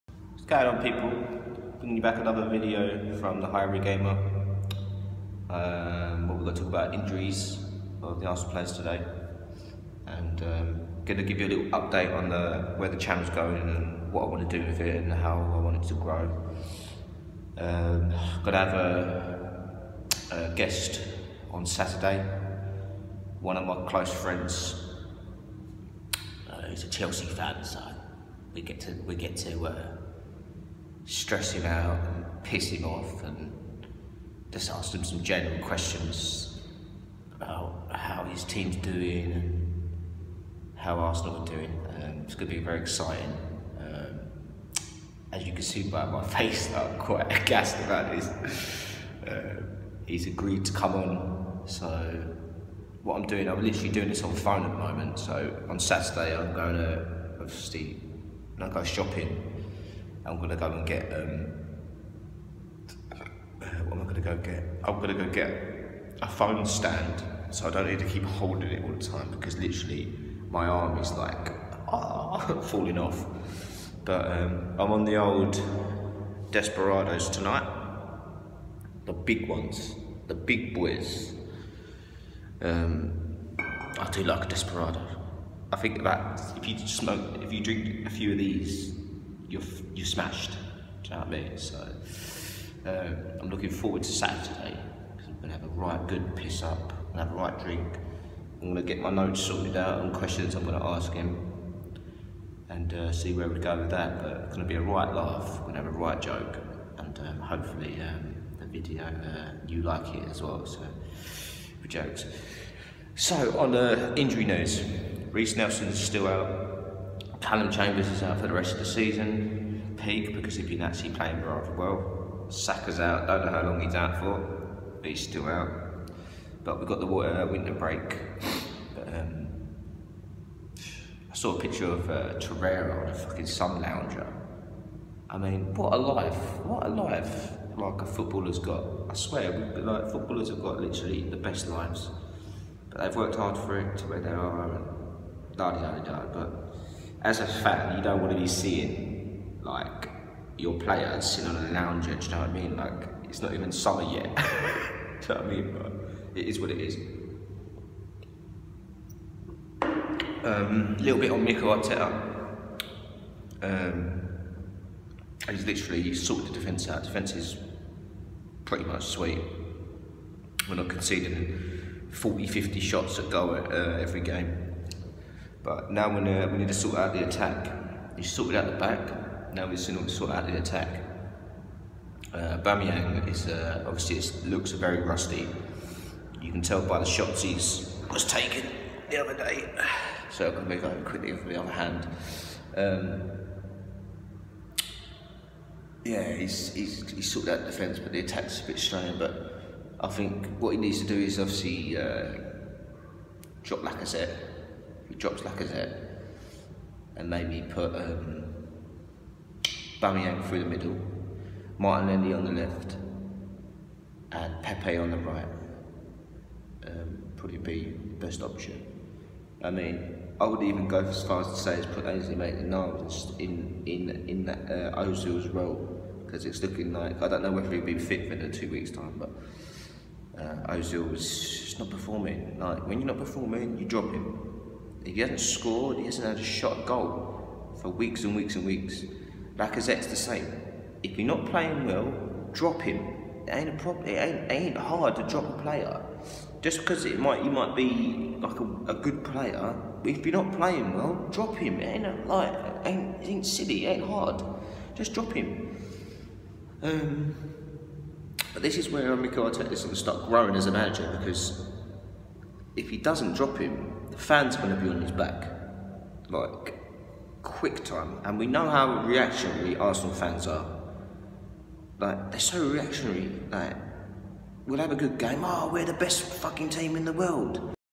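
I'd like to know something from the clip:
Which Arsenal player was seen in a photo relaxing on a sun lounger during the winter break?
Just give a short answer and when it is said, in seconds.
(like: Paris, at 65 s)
Torreira, at 132 s.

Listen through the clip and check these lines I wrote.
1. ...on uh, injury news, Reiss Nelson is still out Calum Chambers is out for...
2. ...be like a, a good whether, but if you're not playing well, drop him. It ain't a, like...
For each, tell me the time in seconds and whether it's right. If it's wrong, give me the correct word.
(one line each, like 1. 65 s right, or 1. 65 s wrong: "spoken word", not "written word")
1. 113 s right
2. 247 s wrong: "player", not "whether".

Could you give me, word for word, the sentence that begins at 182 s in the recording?
Uh, Aubameyang is uh, obviously it looks very rusty.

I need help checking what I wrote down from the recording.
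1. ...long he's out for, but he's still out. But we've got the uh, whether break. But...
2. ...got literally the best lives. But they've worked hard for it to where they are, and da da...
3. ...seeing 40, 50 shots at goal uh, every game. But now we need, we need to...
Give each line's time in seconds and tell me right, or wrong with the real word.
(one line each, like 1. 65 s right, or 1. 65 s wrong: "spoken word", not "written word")
1. 123 s wrong: "winter", not "whether"
2. 140 s right
3. 170 s wrong: "conceding", not "seeing".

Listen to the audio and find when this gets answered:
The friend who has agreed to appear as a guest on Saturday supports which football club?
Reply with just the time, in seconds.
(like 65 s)
26 s.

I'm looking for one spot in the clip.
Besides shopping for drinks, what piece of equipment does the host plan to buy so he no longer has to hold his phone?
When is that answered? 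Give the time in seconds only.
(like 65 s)
66 s.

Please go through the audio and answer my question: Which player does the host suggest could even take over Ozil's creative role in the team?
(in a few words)
Ainsley Maitland-Niles.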